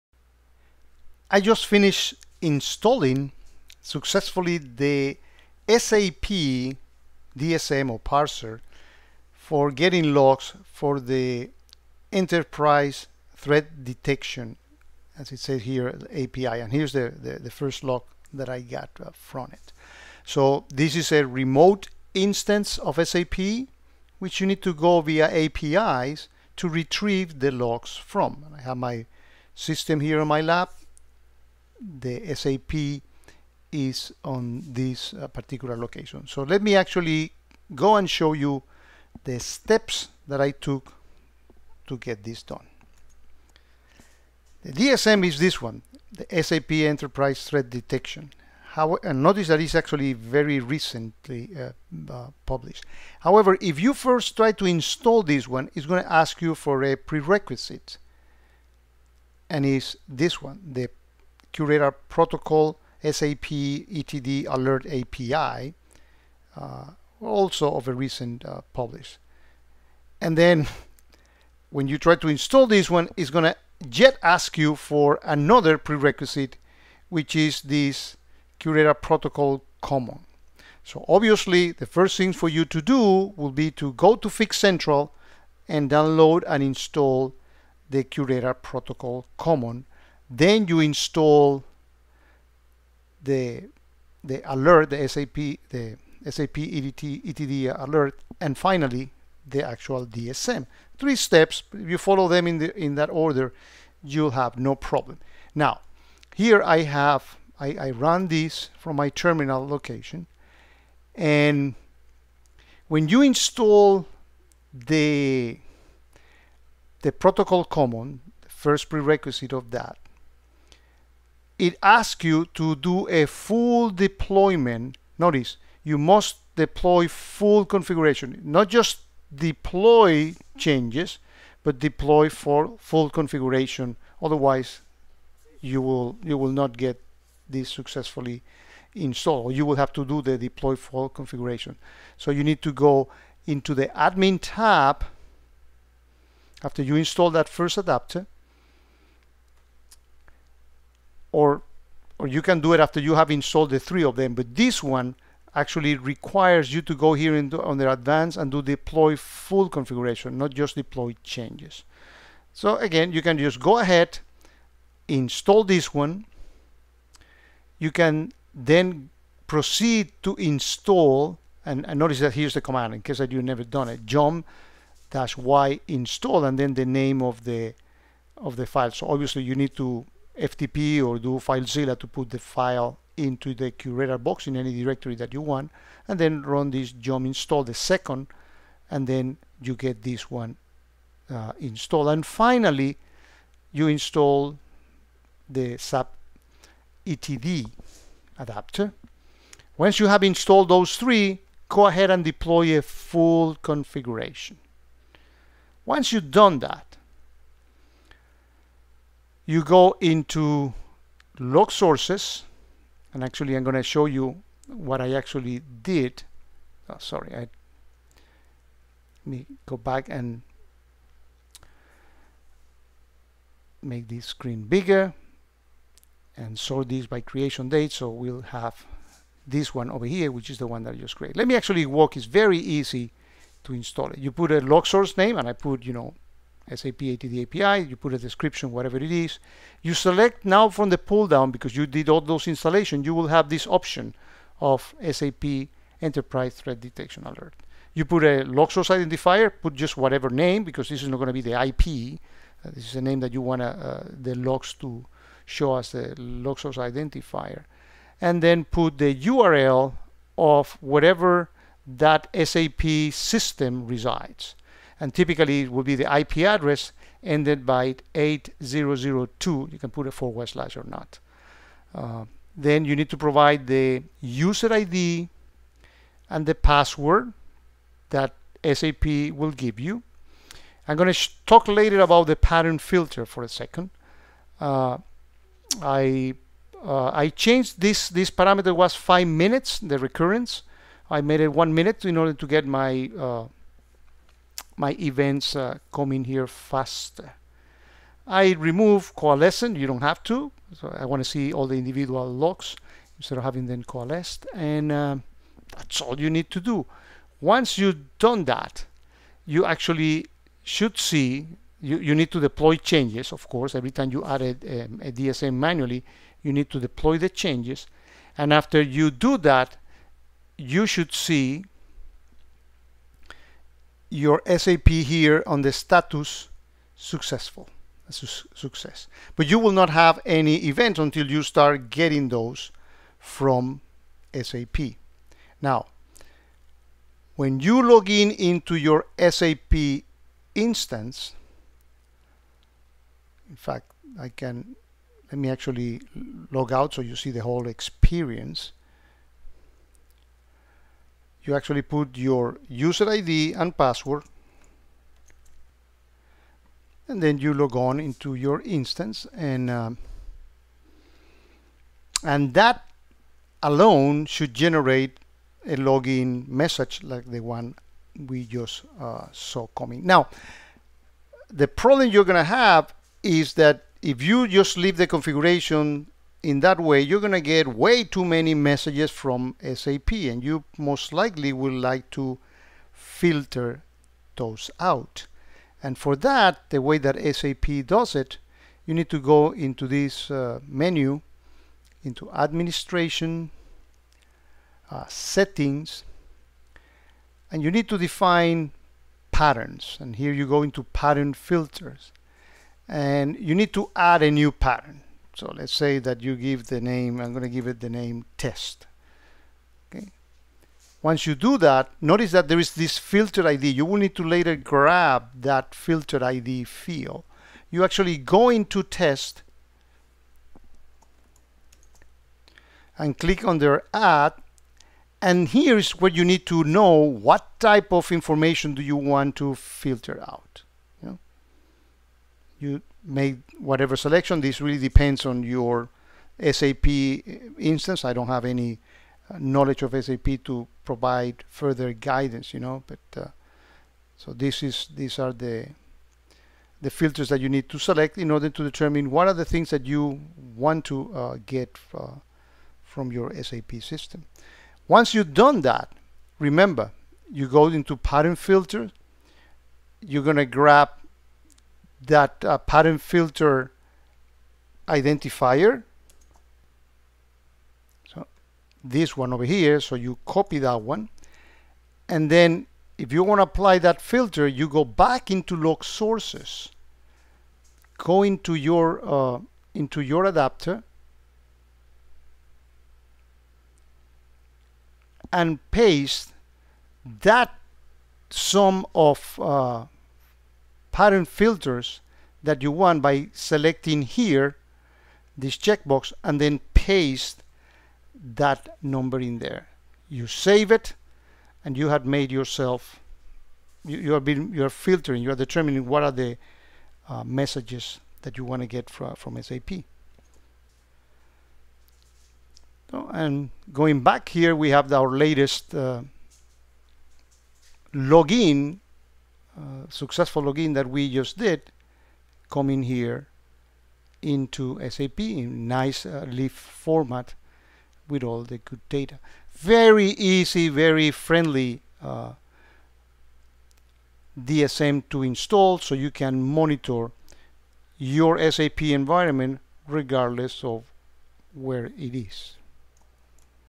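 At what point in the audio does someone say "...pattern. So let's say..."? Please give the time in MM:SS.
06:44.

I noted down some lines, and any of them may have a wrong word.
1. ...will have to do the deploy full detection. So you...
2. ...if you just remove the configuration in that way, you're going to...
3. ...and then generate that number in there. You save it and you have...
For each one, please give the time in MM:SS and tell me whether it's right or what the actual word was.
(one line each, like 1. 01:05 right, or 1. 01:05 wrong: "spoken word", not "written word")
1. 02:19 wrong: "configuration", not "detection"
2. 06:14 wrong: "leave", not "remove"
3. 08:16 wrong: "paste", not "generate".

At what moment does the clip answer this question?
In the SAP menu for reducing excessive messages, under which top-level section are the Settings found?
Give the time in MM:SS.
06:32.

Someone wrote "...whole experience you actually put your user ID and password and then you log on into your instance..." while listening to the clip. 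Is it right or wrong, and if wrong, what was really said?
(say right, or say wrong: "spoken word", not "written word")
right.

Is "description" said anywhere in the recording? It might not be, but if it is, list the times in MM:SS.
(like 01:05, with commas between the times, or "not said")
03:58.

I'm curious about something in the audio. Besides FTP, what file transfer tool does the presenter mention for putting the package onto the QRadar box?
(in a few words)
FileZilla.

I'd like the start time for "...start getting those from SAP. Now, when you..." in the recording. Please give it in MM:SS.
05:31.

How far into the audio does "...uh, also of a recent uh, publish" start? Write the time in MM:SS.
01:06.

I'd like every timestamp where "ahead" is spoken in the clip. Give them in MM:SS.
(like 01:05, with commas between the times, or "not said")
02:43, 03:21.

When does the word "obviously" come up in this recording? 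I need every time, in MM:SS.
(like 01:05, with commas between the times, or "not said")
01:21, 02:59.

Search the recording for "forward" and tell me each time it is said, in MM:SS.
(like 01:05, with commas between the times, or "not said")
04:30.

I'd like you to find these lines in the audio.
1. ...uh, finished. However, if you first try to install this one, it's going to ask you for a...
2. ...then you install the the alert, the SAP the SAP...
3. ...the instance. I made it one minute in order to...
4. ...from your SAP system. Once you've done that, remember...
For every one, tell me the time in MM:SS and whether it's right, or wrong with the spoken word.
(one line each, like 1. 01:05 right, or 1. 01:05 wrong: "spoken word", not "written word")
1. 00:52 wrong: "published", not "finished"
2. 01:30 right
3. 04:49 wrong: "recurrence", not "instance"
4. 07:32 right.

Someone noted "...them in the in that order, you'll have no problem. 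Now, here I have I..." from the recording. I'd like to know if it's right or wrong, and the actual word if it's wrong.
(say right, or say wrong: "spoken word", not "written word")
right.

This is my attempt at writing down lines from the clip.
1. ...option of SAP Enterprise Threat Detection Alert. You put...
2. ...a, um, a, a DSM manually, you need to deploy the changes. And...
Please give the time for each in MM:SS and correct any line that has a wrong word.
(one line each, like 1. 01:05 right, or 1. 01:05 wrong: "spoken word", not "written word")
1. 04:03 right
2. 05:14 right.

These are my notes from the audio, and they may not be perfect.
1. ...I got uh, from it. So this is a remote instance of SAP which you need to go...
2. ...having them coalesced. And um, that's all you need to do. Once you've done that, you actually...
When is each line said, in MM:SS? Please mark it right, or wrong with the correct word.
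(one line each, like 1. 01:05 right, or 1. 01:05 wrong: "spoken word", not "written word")
1. 00:18 right
2. 05:03 right.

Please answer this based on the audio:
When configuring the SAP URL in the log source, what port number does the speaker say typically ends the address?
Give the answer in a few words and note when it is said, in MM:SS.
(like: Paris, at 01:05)
8002, at 04:28.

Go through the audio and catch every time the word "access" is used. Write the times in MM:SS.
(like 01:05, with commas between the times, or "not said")
not said.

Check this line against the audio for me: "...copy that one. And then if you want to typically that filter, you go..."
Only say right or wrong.
wrong.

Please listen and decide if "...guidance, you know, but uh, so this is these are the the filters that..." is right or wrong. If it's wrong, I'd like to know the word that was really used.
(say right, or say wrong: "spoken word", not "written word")
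right.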